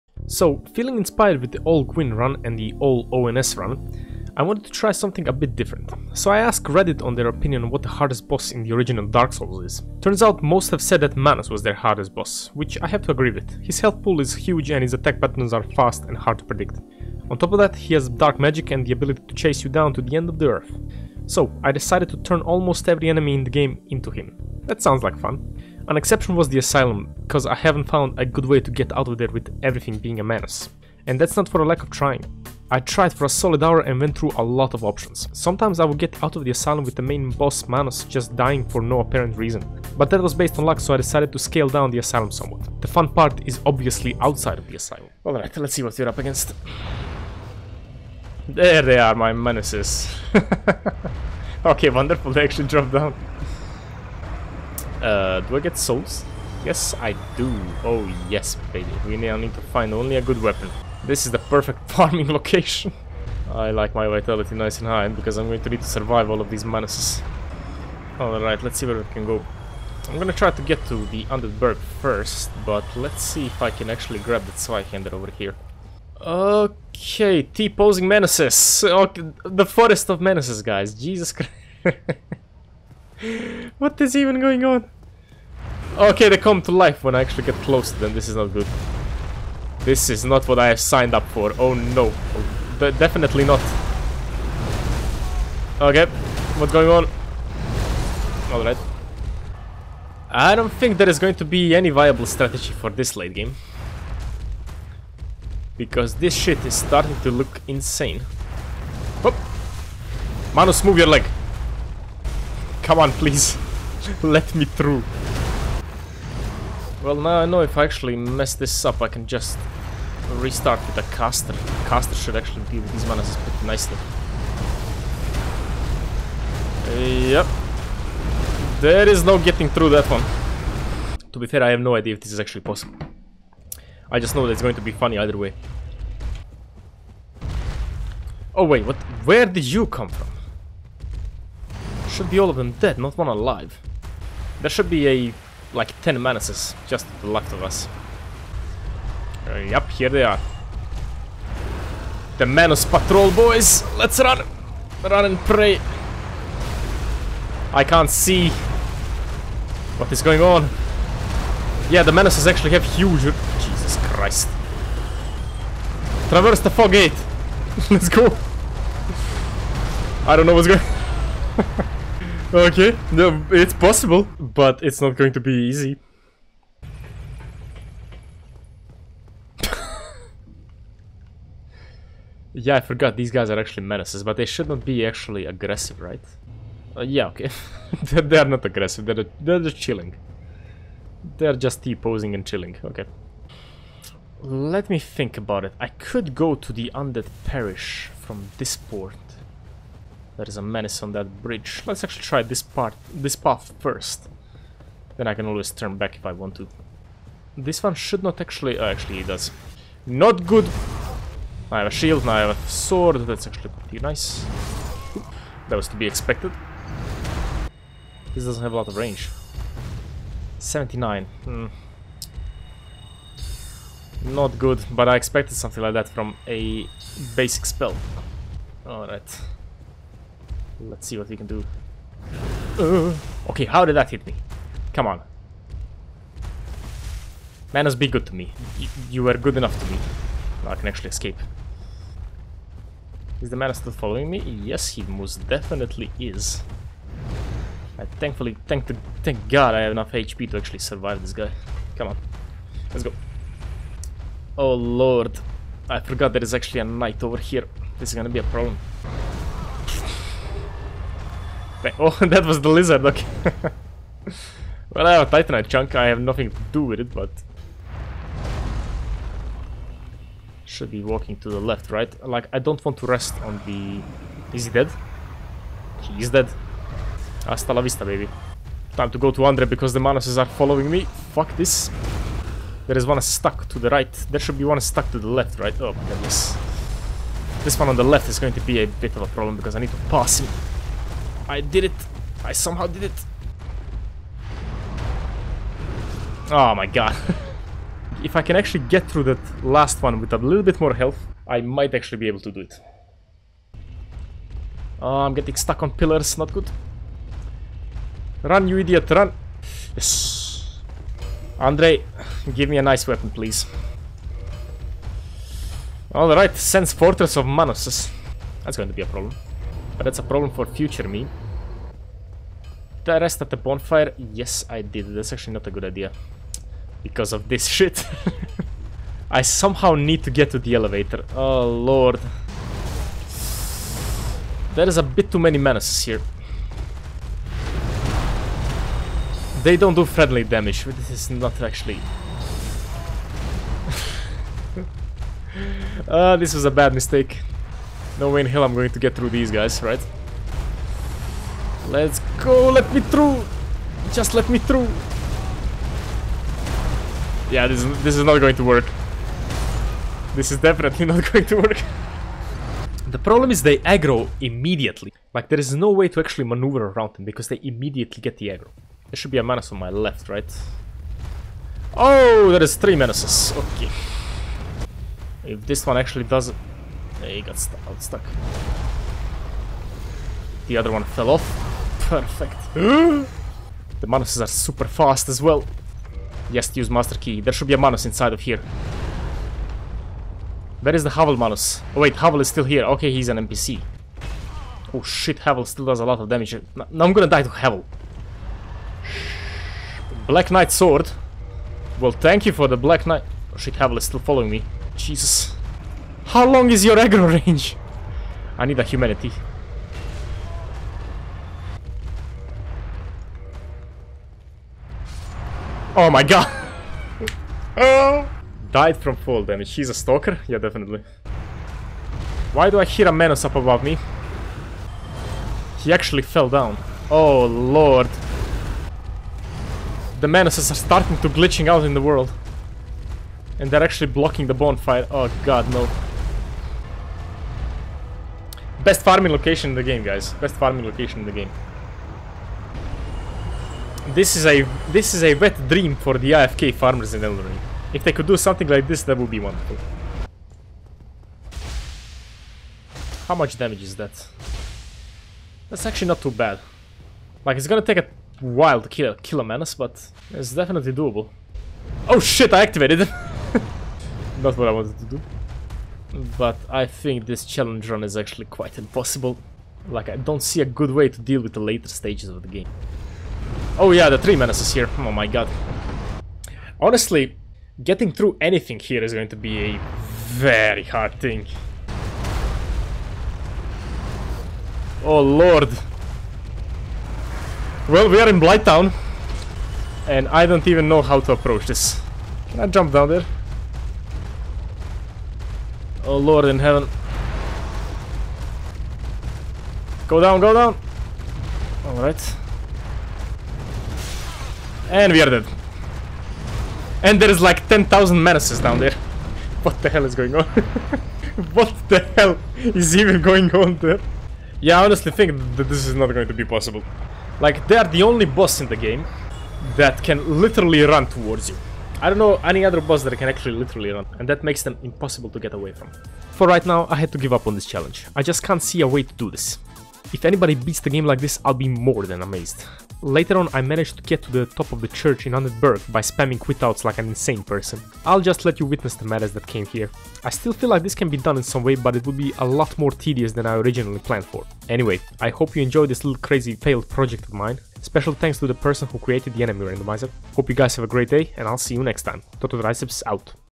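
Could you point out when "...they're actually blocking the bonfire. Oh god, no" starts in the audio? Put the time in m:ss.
7:13.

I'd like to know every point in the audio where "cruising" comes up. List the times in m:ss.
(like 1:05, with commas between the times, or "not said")
not said.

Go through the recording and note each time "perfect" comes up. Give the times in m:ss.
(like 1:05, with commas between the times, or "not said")
1:01, 6:22.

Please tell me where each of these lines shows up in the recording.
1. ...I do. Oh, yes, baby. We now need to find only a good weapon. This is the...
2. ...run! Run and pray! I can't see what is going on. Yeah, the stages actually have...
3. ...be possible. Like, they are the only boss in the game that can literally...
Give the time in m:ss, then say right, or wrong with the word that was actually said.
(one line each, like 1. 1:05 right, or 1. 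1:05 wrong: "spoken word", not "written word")
1. 0:56 right
2. 2:34 wrong: "menaces", not "stages"
3. 8:36 right.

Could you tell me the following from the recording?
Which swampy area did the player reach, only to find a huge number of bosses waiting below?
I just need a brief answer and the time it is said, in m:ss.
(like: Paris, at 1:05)
Blighttown, at 8:08.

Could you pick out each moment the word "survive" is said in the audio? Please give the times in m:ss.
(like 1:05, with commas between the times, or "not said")
1:05, 4:10.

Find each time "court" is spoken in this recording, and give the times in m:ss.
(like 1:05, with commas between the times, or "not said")
not said.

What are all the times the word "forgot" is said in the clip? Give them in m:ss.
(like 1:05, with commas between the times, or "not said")
3:02, 4:16.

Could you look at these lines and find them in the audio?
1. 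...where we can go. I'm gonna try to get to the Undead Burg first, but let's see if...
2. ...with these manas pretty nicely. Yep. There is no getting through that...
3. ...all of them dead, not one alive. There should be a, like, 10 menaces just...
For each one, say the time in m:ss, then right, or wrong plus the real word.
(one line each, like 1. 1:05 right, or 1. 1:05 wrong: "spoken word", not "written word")
1. 1:08 right
2. 2:02 right
3. 2:22 right.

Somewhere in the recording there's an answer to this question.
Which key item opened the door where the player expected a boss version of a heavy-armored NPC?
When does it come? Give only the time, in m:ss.
6:26.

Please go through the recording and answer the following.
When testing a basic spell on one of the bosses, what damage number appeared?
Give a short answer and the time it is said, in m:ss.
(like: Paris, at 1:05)
79, at 3:40.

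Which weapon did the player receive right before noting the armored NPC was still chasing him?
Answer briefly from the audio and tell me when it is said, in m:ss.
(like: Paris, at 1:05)
Black Knight Sword, at 6:40.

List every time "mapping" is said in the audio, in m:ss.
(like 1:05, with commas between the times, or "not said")
not said.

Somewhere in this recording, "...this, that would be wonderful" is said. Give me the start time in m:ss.
7:28.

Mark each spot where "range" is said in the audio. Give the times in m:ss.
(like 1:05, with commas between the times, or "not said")
3:38, 6:47.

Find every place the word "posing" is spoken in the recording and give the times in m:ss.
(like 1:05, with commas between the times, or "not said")
1:17, 3:11.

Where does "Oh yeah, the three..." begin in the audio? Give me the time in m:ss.
7:53.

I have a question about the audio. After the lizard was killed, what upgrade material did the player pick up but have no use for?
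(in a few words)
Titanite chunk.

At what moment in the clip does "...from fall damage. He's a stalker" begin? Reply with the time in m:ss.
6:58.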